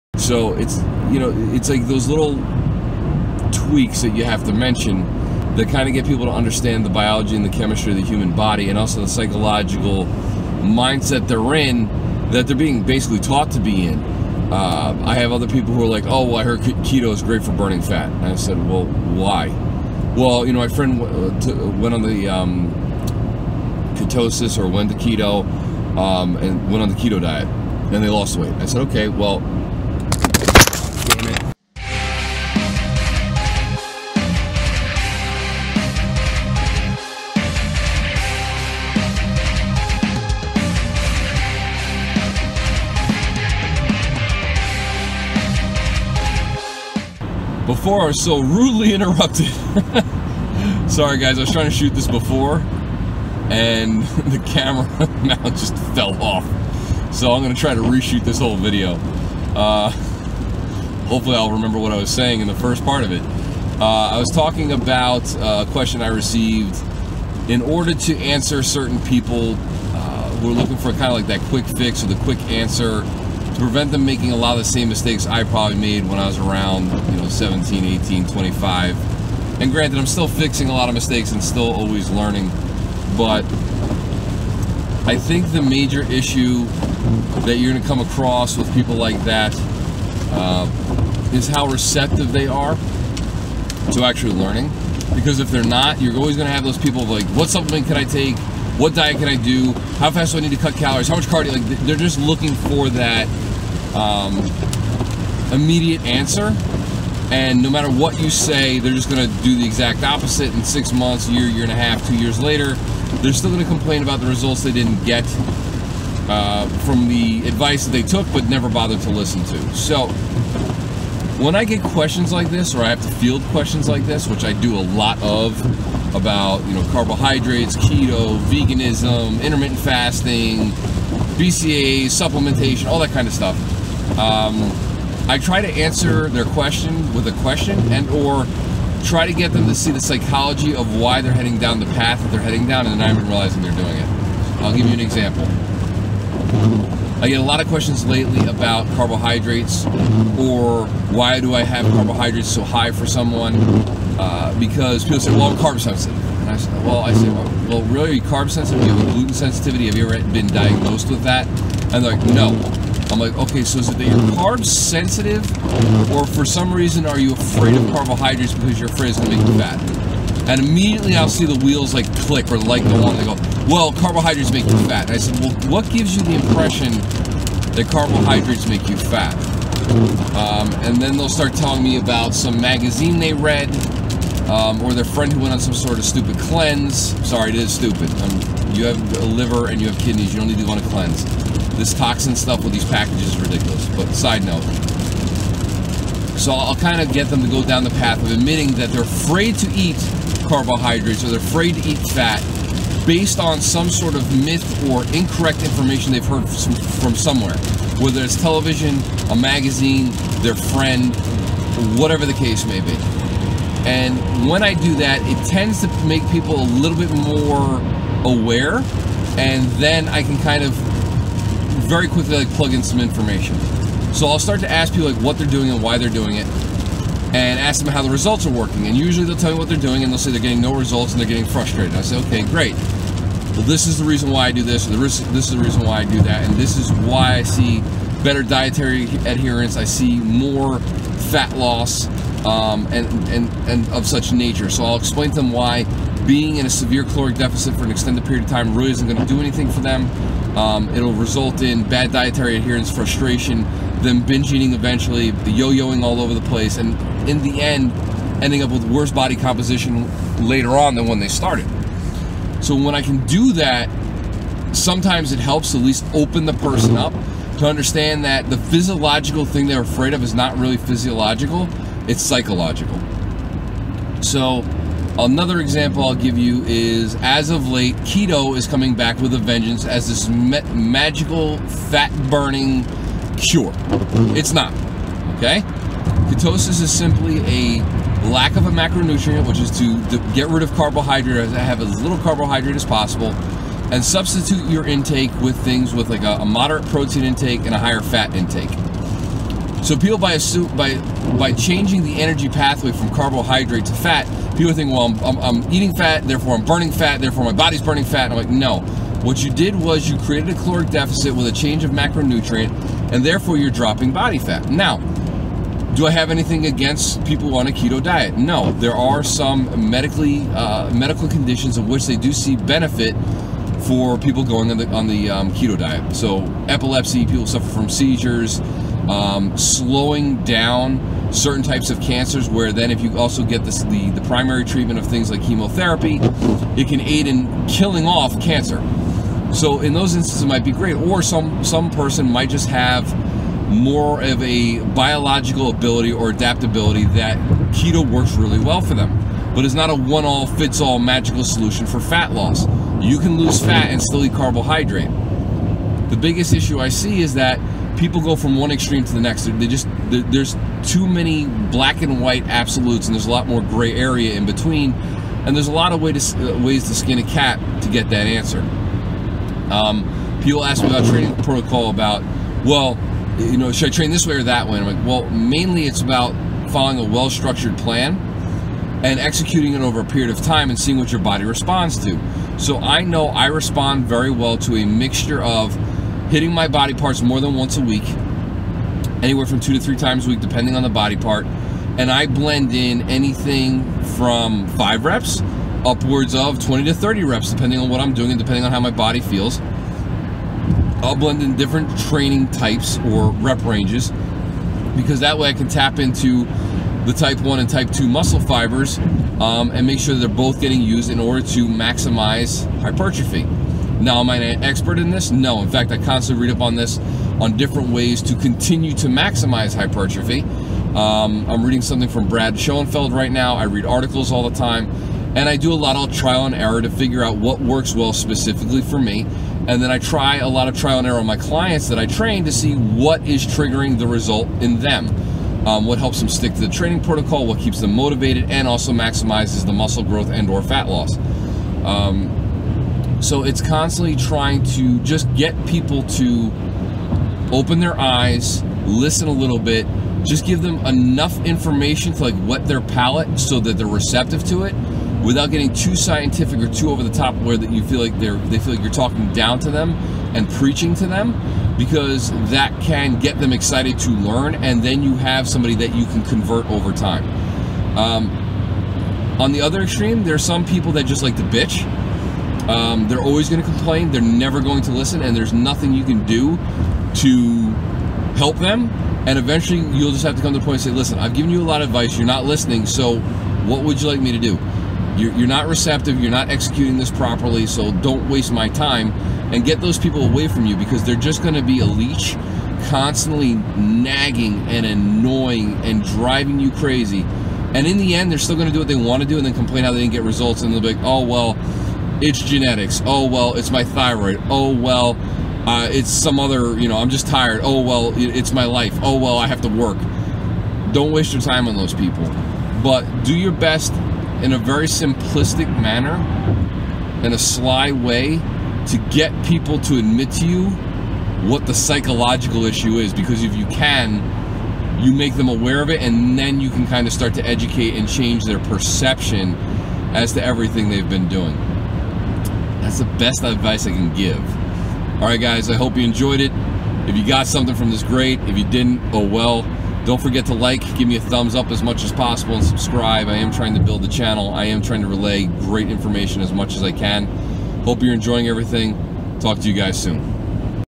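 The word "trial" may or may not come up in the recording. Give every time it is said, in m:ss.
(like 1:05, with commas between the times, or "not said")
7:06, 7:10.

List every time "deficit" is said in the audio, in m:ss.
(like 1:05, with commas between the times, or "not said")
4:07, 5:10.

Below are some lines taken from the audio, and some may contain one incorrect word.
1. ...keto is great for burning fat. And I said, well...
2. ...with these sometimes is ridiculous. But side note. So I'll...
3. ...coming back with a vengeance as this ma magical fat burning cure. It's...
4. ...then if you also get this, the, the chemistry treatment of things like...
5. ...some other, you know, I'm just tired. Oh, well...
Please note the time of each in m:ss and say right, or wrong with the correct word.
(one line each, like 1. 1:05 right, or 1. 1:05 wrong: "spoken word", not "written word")
1. 0:16 right
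2. 3:12 wrong: "packages", not "sometimes"
3. 4:38 right
4. 5:32 wrong: "primary", not "chemistry"
5. 8:26 right.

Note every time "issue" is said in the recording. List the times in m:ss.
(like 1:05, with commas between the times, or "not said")
1:26, 5:56, 8:42.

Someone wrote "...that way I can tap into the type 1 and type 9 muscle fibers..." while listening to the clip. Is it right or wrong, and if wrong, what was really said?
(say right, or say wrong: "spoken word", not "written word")
wrong: "2", not "9".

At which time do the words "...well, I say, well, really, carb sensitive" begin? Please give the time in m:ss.
2:36.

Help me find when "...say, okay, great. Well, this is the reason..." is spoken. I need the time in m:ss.
3:52.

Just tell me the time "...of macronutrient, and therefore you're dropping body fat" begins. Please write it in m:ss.
5:11.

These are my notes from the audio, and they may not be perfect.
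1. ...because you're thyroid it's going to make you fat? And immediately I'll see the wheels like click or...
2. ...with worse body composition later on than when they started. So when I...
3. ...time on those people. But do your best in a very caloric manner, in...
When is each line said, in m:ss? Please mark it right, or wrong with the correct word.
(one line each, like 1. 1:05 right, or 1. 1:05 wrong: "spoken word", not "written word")
1. 2:48 wrong: "afraid", not "thyroid"
2. 4:18 right
3. 8:31 wrong: "simplistic", not "caloric".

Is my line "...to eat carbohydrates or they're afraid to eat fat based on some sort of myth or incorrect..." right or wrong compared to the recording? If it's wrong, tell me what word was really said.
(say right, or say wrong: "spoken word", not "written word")
right.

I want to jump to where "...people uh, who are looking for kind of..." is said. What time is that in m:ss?
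1:09.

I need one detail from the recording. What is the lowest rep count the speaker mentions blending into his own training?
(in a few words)
5 reps.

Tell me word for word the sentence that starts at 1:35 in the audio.
Because if they're not, you're always going to have those people like, what supplement can I take?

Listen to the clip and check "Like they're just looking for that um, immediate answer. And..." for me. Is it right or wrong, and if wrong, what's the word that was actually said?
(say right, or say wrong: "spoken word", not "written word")
right.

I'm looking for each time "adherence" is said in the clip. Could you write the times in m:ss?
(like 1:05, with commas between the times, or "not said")
3:59, 4:12.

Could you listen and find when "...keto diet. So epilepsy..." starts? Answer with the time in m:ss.
5:25.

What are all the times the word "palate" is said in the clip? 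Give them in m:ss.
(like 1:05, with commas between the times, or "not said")
7:32.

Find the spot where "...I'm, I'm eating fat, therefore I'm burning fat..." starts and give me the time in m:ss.
5:05.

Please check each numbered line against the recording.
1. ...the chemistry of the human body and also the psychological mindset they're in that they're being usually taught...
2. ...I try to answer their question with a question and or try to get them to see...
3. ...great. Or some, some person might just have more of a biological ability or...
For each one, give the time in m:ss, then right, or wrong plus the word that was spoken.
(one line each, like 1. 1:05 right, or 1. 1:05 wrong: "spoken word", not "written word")
1. 0:07 wrong: "basically", not "usually"
2. 2:15 right
3. 5:40 right.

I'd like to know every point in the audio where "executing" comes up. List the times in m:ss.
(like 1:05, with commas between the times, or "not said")
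6:19, 8:06.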